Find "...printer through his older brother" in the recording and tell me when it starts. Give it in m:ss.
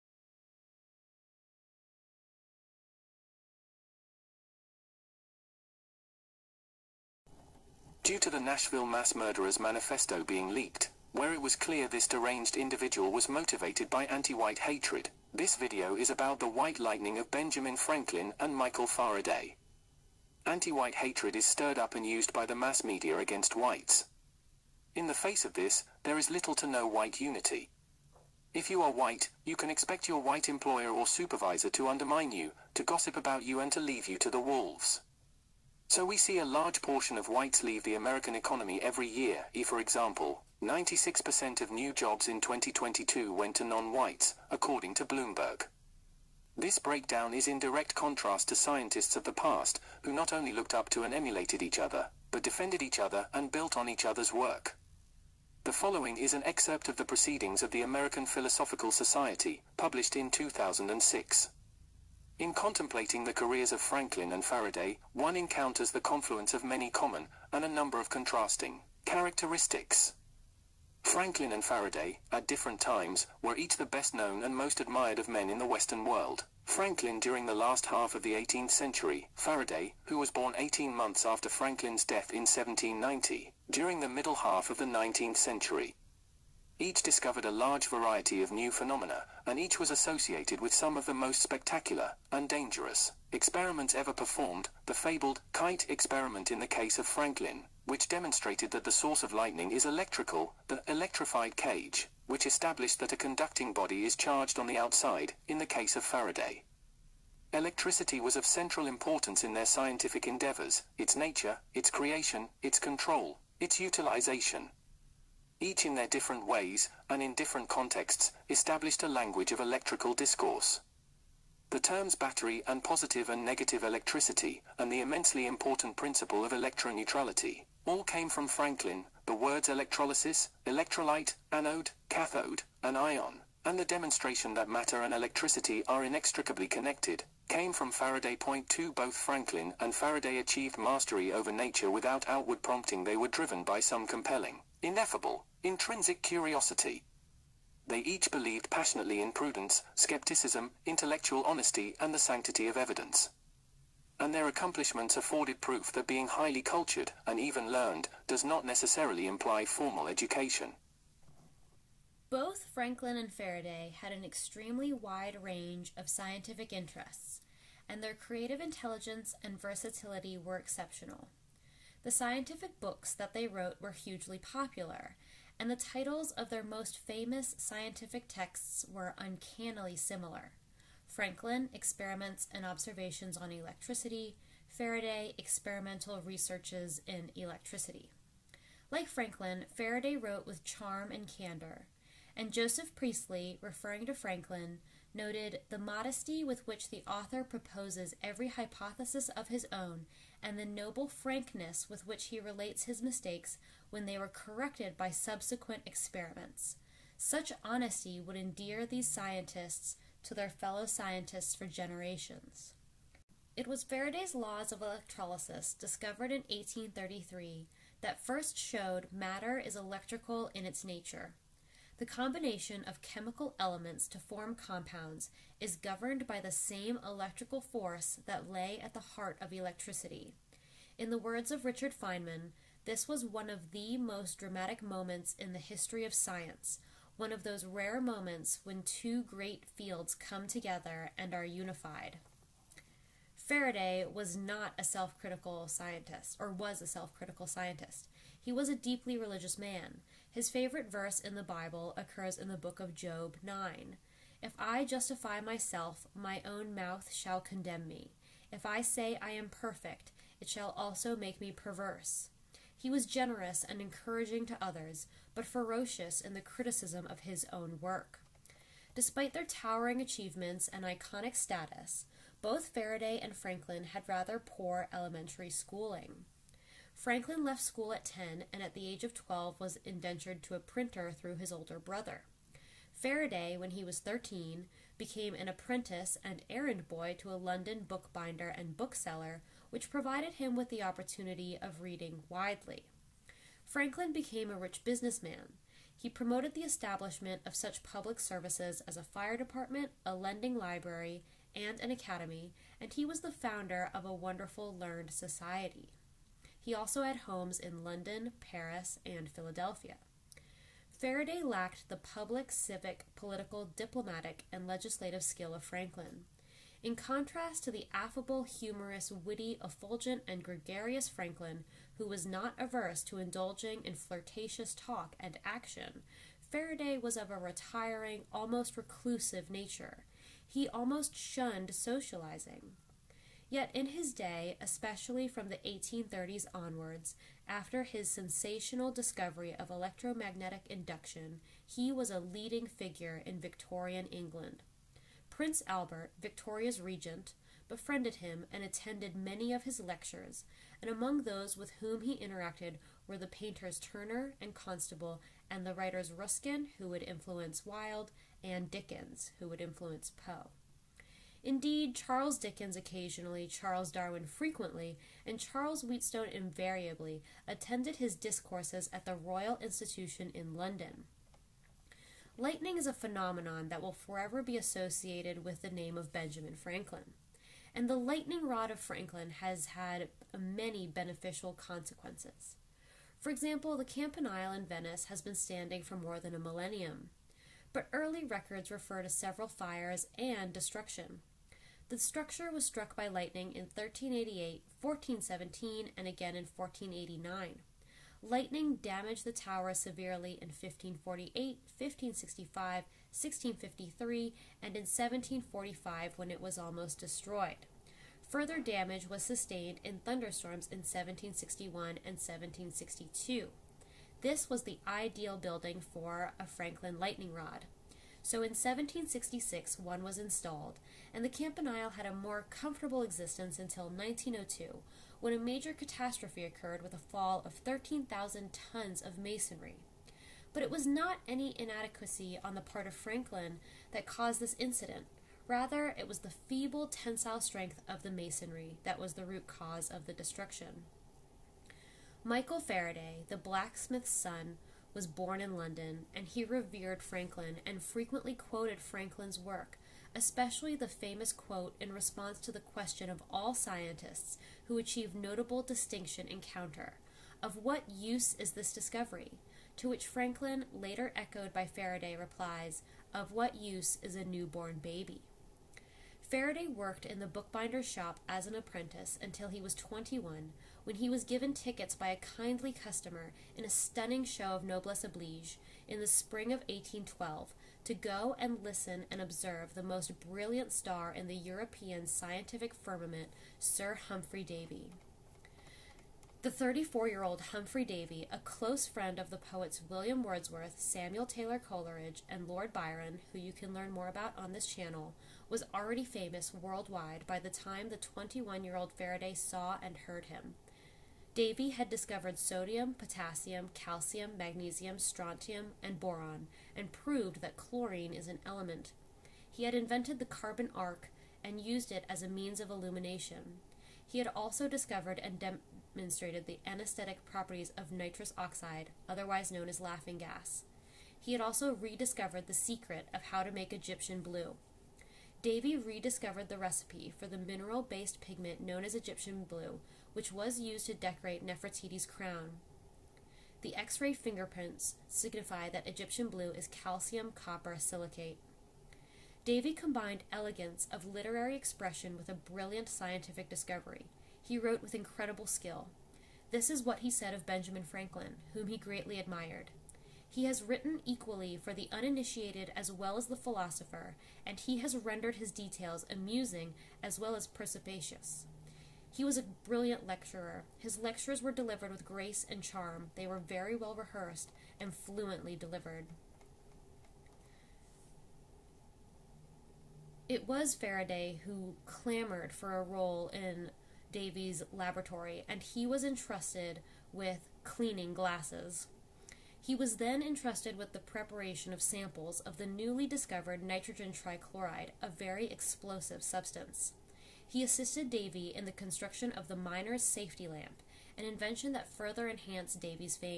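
4:40.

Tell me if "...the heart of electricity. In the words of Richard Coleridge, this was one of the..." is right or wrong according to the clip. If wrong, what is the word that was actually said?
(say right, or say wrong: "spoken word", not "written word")
wrong: "Feynman", not "Coleridge".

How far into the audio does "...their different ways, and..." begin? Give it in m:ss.
1:55.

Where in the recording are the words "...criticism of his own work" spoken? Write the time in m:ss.
4:26.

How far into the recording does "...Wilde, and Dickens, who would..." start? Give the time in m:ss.
5:57.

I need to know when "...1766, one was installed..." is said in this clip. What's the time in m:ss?
6:58.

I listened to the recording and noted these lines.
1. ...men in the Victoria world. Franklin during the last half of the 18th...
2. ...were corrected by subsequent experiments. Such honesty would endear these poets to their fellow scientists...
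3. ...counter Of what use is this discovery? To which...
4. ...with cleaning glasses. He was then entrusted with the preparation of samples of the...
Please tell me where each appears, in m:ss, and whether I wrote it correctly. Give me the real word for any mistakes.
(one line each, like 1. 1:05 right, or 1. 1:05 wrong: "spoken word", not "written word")
1. 1:15 wrong: "Western", not "Victoria"
2. 3:24 wrong: "scientists", not "poets"
3. 7:36 right
4. 9:37 right.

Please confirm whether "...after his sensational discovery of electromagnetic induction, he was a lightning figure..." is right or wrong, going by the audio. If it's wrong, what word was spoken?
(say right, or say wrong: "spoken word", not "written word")
wrong: "leading", not "lightning".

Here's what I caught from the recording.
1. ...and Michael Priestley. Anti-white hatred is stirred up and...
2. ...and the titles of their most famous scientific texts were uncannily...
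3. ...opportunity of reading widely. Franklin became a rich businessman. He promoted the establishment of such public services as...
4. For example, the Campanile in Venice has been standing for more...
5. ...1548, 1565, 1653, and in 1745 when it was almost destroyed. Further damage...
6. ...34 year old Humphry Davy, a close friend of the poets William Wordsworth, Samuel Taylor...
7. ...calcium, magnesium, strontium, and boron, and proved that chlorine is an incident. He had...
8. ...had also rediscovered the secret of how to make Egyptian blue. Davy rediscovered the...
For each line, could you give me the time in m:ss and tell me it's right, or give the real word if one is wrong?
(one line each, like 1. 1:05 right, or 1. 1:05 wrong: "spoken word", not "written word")
1. 0:18 wrong: "Faraday", not "Priestley"
2. 2:55 right
3. 4:50 right
4. 6:23 right
5. 6:40 right
6. 8:06 right
7. 8:23 wrong: "element", not "incident"
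8. 8:41 right.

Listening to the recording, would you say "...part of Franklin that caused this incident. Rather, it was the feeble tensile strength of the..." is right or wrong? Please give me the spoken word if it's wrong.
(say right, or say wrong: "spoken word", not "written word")
right.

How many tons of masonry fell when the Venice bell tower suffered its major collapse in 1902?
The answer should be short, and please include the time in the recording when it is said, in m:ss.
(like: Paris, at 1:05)
13,000, at 7:07.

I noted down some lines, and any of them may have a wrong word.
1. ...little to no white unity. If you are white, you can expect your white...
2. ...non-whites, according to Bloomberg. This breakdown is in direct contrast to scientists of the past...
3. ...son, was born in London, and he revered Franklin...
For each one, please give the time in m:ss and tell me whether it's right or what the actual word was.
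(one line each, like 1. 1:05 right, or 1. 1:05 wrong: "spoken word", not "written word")
1. 0:26 right
2. 0:43 right
3. 7:24 right.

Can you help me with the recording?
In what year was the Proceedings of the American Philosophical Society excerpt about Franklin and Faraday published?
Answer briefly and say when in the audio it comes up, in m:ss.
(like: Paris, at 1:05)
2006, at 1:00.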